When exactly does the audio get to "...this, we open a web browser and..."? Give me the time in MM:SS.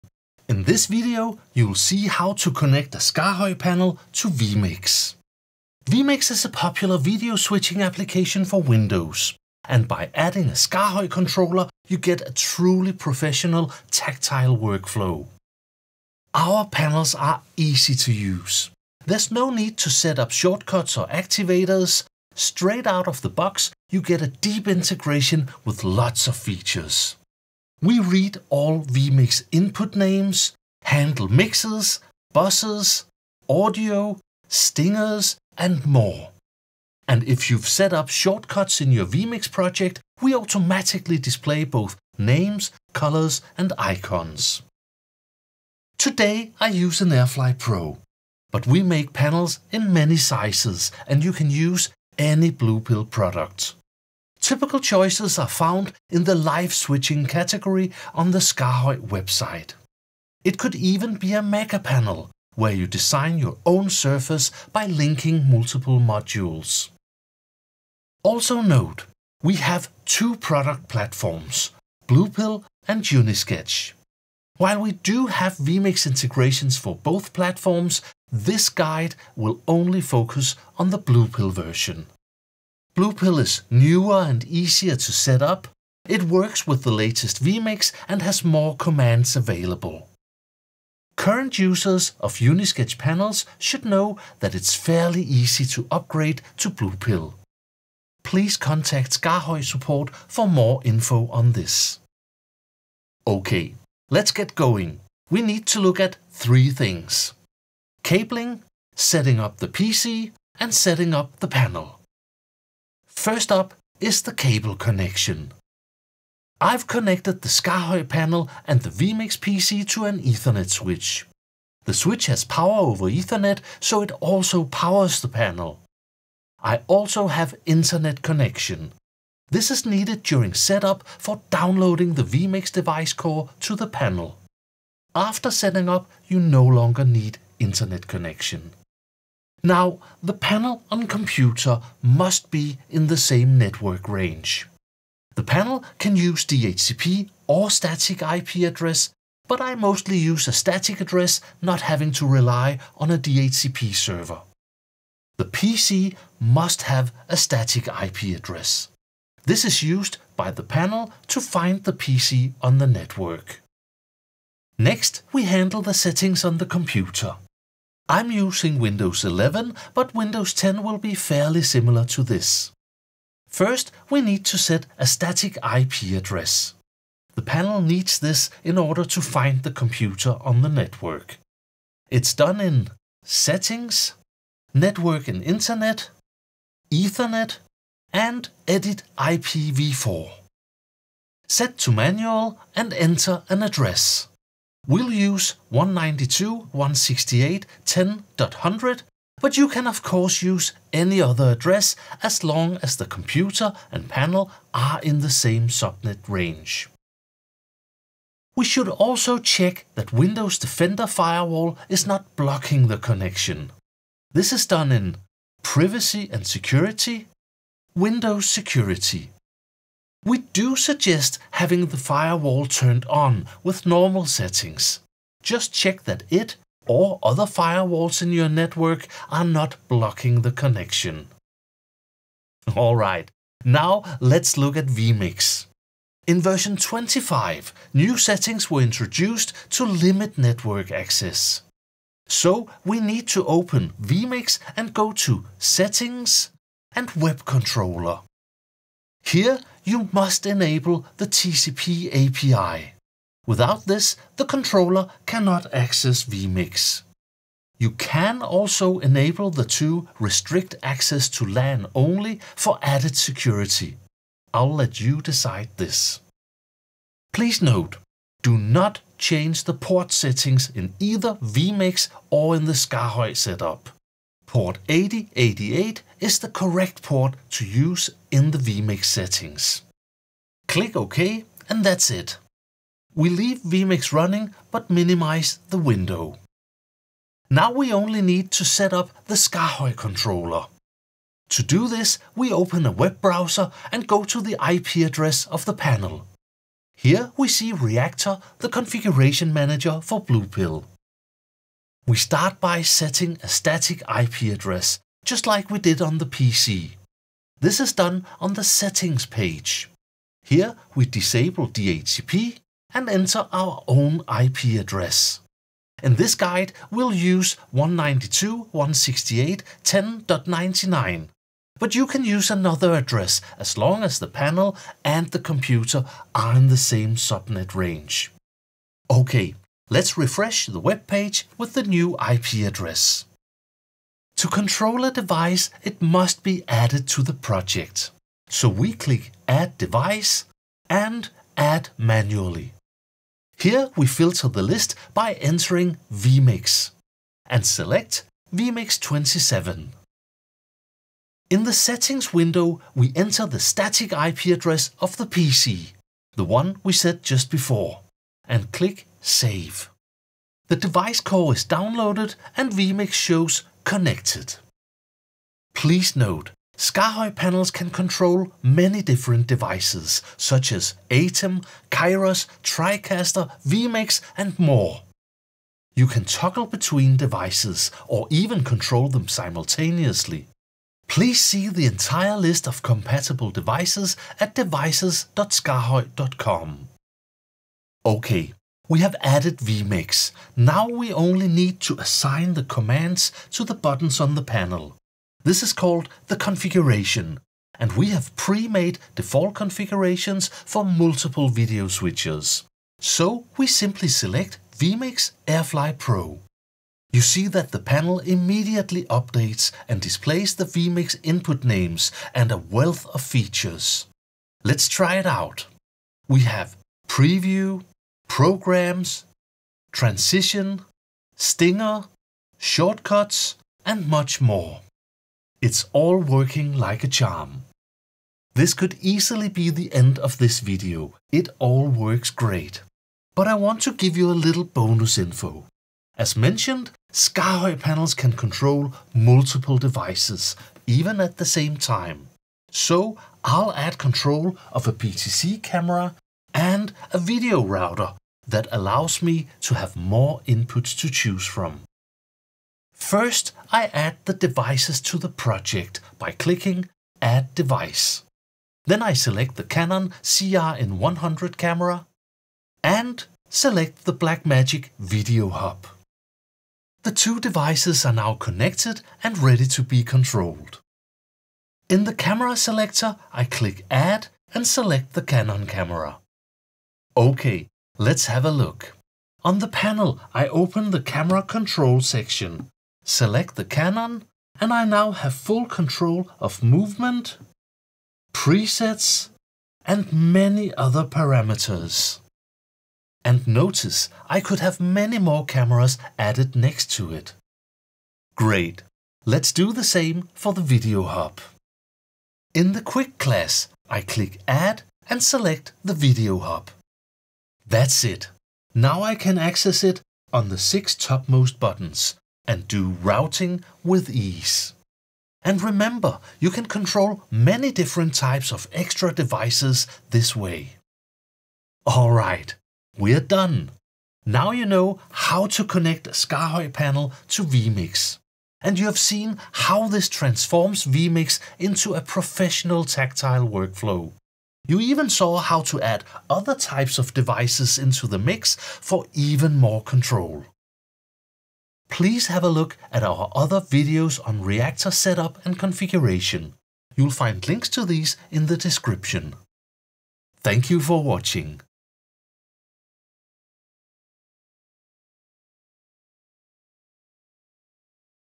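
04:51.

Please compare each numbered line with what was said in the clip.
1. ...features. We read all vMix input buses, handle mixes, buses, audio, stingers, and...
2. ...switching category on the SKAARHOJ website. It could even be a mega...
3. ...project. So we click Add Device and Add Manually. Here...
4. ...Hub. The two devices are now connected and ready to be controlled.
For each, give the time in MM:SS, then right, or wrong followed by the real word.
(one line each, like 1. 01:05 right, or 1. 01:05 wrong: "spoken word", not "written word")
1. 00:26 wrong: "names", not "buses"
2. 00:56 right
3. 05:37 right
4. 07:45 right.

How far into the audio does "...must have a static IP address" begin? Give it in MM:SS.
02:36.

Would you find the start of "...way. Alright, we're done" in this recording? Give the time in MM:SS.
08:40.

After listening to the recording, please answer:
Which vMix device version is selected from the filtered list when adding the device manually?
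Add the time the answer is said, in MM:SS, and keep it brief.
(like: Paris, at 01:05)
vMix 27, at 05:48.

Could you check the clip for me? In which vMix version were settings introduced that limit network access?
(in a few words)
25.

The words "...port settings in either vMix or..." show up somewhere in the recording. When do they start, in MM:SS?
04:29.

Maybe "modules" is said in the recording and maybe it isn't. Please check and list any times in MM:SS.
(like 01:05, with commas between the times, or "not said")
01:06.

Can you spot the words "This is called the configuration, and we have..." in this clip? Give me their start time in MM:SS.
06:35.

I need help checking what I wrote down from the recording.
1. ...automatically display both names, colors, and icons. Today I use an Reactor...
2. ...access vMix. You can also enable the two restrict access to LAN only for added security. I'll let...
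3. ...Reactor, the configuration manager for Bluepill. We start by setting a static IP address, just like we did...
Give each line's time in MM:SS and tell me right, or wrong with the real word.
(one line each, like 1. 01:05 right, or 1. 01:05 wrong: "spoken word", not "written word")
1. 00:40 wrong: "Airfly", not "Reactor"
2. 04:15 right
3. 04:57 right.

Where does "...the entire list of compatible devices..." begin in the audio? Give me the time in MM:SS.
06:21.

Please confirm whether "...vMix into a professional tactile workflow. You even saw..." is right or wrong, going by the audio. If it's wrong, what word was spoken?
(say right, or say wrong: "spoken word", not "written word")
right.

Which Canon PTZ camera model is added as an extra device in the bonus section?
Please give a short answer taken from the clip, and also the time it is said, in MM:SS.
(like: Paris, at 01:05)
Canon CRN100, at 07:39.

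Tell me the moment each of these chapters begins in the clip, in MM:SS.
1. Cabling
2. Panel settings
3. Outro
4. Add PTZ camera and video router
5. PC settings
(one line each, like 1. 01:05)
1. 01:55
2. 04:48
3. 08:42
4. 07:17
5. 02:45.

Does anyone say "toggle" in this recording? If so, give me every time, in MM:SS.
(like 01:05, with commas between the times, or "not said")
06:16.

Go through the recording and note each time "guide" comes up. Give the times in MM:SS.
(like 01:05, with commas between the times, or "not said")
01:18, 05:16.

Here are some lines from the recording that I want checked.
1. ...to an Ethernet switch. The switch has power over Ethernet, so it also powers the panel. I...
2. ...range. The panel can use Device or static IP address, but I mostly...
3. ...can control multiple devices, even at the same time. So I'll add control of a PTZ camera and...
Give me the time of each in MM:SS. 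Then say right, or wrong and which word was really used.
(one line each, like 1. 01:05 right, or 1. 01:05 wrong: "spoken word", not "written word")
1. 01:59 right
2. 02:24 wrong: "DHCP", not "Device"
3. 07:18 right.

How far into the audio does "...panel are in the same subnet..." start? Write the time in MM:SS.
03:24.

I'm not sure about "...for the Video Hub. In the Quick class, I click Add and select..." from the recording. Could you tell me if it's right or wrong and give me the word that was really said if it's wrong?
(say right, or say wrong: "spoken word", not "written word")
right.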